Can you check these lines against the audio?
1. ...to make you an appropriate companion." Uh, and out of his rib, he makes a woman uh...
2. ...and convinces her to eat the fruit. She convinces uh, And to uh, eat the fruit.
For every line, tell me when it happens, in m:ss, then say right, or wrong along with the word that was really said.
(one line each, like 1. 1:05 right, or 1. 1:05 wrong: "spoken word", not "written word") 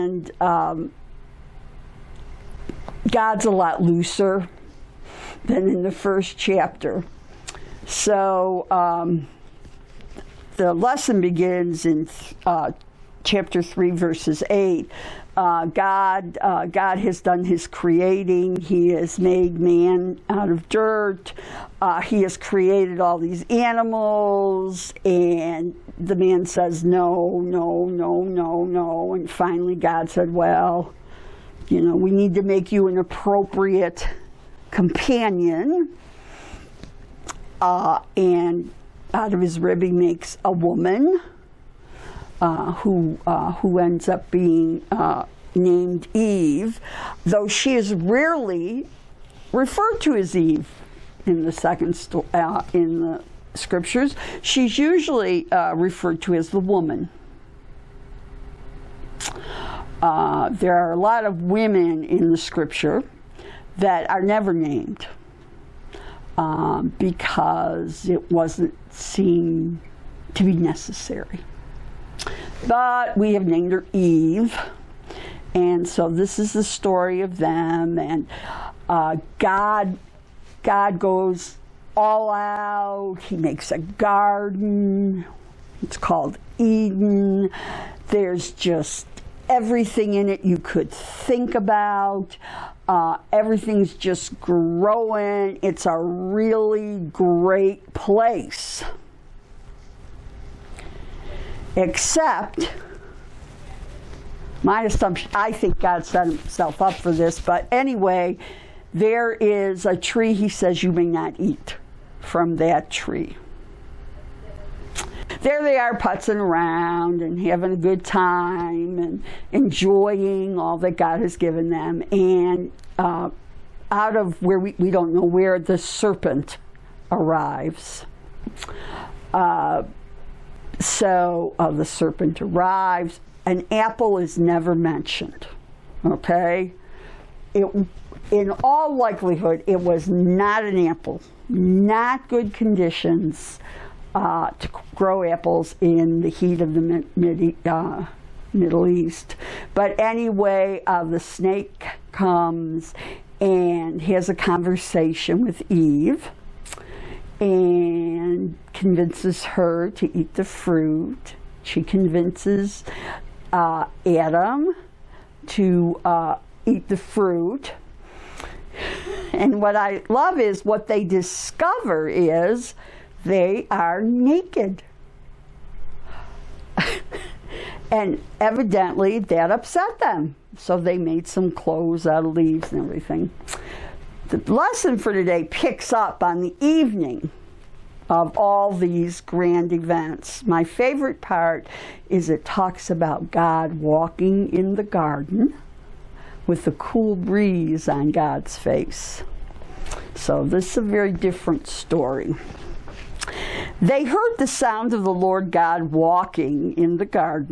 1. 0:32 right
2. 2:38 wrong: "Adam", not "And".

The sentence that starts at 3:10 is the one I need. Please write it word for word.
My favorite part is it talks about God walking in the garden with the cool breeze on God's face.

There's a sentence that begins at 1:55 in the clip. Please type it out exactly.
There they are putzing around and having a good time and enjoying all that God has given them.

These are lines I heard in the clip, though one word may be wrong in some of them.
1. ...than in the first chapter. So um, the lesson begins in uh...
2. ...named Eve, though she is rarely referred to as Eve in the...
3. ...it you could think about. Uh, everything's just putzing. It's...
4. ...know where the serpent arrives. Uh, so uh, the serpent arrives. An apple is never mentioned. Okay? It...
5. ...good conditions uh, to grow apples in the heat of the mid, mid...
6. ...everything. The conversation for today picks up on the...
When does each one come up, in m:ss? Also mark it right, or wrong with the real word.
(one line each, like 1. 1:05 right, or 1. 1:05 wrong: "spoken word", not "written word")
1. 0:05 right
2. 0:45 right
3. 1:30 wrong: "growing", not "putzing"
4. 2:05 right
5. 2:22 right
6. 3:02 wrong: "lesson", not "conversation".